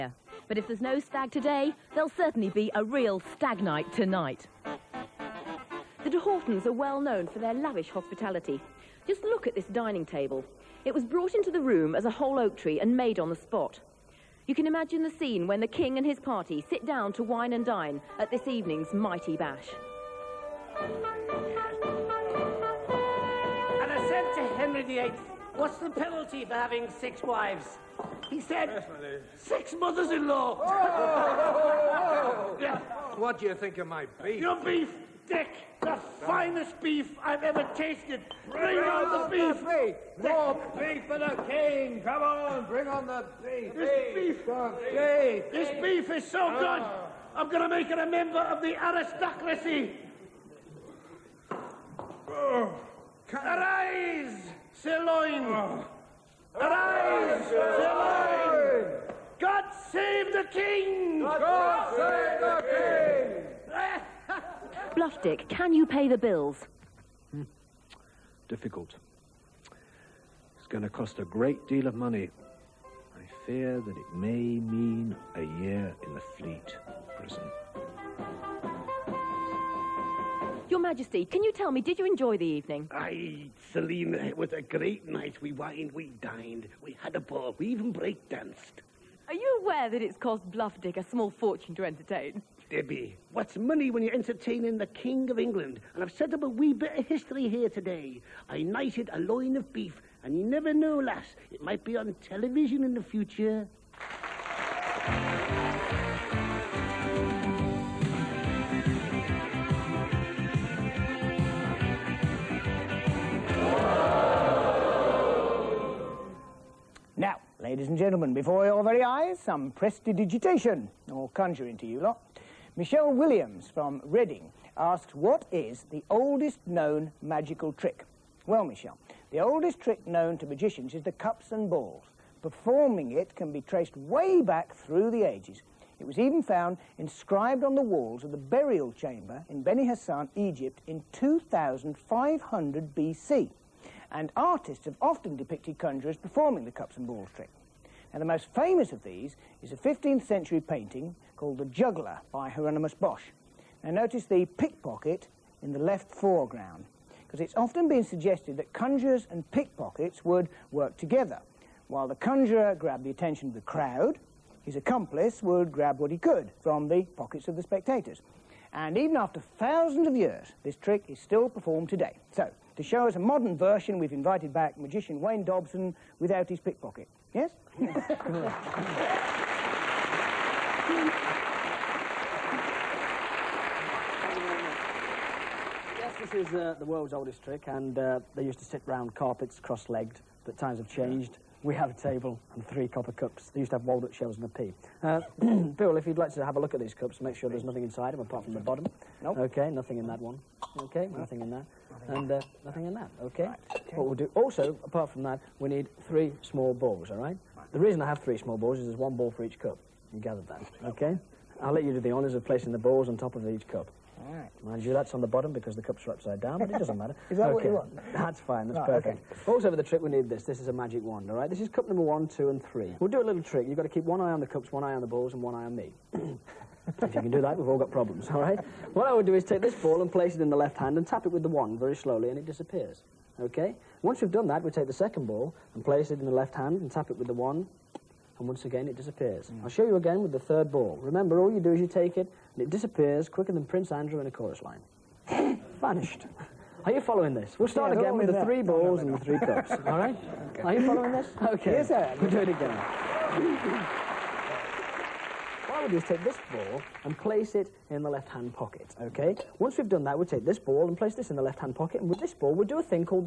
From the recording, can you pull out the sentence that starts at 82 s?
Aye, Selina, it was a great night.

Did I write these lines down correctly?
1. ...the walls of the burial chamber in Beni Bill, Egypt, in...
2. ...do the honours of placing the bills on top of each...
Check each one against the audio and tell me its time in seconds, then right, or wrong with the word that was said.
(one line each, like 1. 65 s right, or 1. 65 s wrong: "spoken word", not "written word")
1. 137 s wrong: "Hassan", not "Bill"
2. 211 s wrong: "balls", not "bills".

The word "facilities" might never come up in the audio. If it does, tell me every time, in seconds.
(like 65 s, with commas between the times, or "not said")
not said.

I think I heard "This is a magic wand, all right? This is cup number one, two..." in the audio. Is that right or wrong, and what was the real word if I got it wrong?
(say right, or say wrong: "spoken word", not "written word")
right.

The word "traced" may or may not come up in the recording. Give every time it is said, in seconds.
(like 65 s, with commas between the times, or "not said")
133 s.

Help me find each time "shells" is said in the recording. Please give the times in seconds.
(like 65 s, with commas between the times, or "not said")
194 s.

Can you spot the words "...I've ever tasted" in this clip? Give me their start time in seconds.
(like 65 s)
37 s.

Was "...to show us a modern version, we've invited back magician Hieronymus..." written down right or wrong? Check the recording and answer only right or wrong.
wrong.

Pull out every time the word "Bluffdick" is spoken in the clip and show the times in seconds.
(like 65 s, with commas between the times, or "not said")
64 s, 90 s.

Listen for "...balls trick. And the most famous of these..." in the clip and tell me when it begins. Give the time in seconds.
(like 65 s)
147 s.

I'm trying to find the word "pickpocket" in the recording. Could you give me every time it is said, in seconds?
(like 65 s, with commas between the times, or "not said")
154 s, 159 s, 176 s.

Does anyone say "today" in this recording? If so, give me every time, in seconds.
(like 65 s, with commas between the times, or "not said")
1 s, 97 s, 171 s.